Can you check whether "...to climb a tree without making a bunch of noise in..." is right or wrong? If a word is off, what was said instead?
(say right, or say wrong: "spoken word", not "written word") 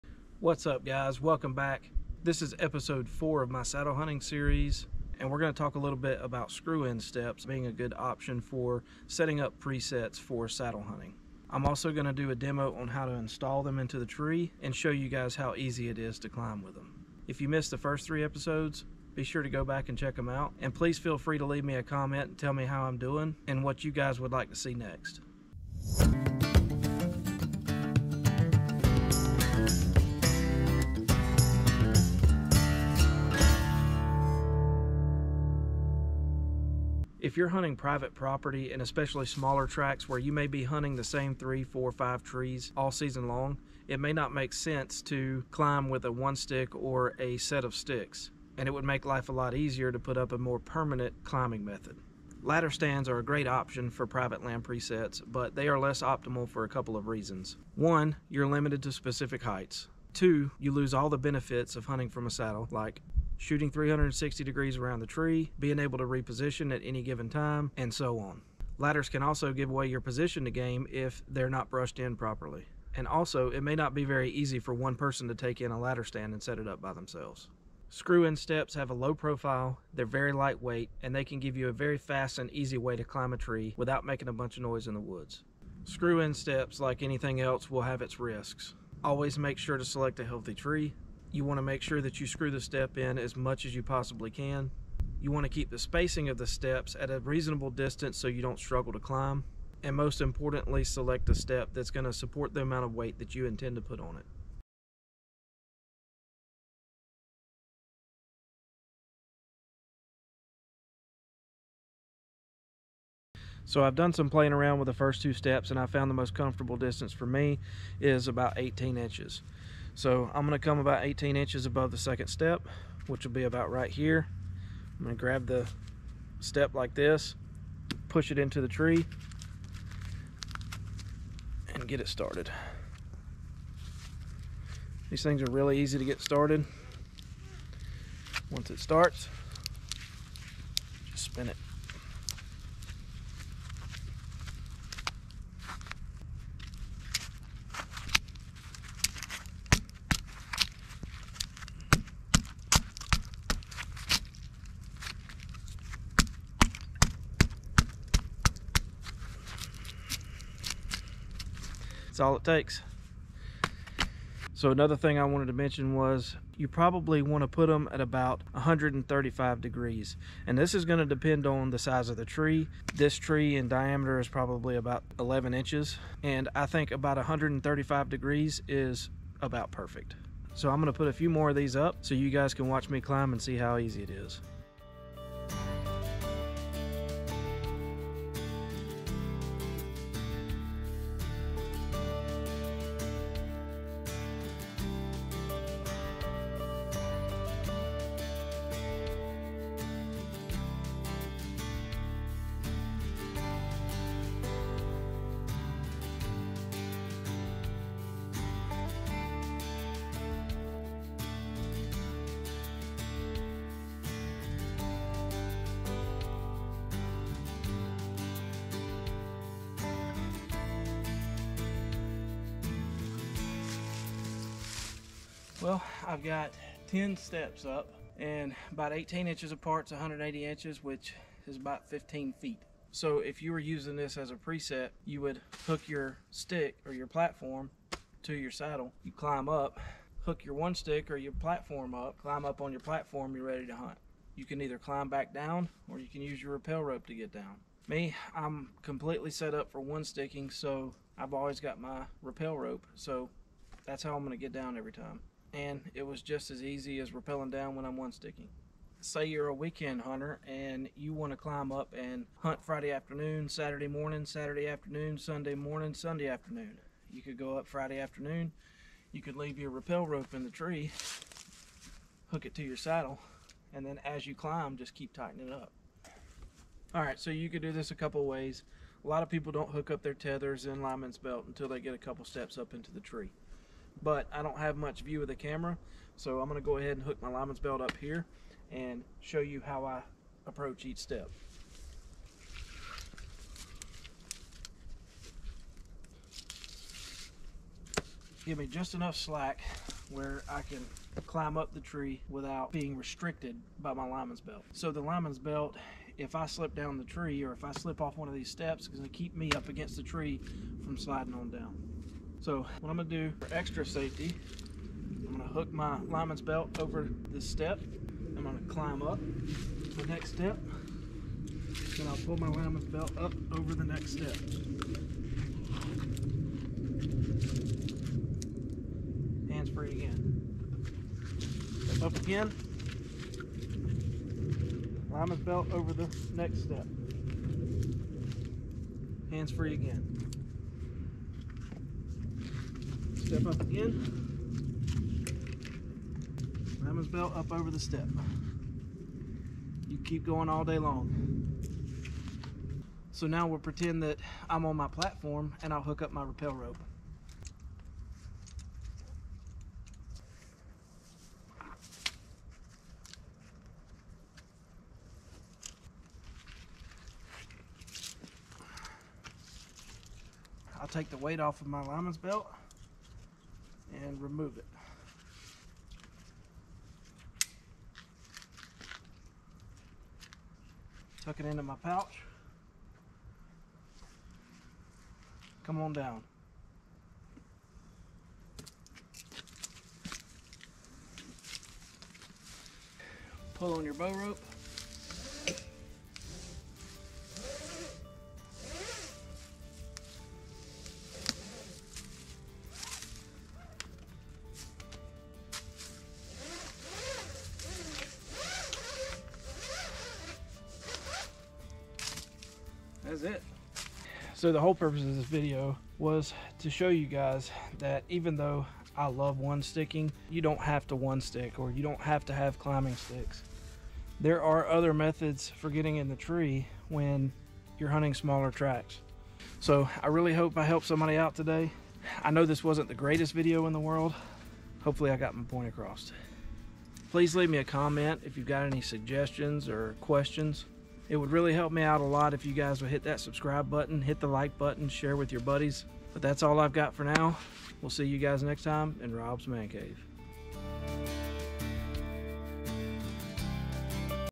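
right.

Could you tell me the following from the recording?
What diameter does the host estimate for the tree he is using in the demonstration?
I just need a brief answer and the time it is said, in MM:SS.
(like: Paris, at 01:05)
11 inches, at 02:54.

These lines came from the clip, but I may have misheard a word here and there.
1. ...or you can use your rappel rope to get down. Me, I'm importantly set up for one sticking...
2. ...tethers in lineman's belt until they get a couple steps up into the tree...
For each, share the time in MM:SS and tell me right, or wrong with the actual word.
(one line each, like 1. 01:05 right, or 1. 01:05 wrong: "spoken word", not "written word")
1. 04:05 wrong: "completely", not "importantly"
2. 04:40 right.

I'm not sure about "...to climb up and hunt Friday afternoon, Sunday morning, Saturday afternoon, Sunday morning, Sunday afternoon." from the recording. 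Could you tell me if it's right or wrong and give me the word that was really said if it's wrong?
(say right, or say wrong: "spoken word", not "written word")
wrong: "Saturday", not "Sunday".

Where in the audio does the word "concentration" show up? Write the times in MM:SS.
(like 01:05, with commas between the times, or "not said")
not said.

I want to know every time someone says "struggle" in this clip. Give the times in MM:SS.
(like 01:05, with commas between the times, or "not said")
01:38.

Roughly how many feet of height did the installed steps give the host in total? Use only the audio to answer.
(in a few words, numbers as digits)
15 feet.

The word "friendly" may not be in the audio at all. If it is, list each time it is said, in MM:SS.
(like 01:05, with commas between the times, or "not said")
not said.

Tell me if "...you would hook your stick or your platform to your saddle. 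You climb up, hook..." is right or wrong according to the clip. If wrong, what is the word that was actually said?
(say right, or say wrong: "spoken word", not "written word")
right.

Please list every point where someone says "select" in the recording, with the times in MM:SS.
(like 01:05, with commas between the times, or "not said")
01:29, 01:40.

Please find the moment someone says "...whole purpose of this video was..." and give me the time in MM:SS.
06:54.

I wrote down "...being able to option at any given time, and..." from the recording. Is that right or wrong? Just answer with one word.
wrong.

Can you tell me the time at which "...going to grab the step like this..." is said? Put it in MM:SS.
02:05.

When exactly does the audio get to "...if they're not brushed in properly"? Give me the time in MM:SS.
01:10.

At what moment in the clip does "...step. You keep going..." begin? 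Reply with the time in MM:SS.
05:47.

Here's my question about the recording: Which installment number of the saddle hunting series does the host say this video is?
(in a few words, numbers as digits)
4.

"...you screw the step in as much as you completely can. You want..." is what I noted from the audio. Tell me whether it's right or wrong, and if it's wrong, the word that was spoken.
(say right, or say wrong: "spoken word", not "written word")
wrong: "possibly", not "completely".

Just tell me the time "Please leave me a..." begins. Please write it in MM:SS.
07:17.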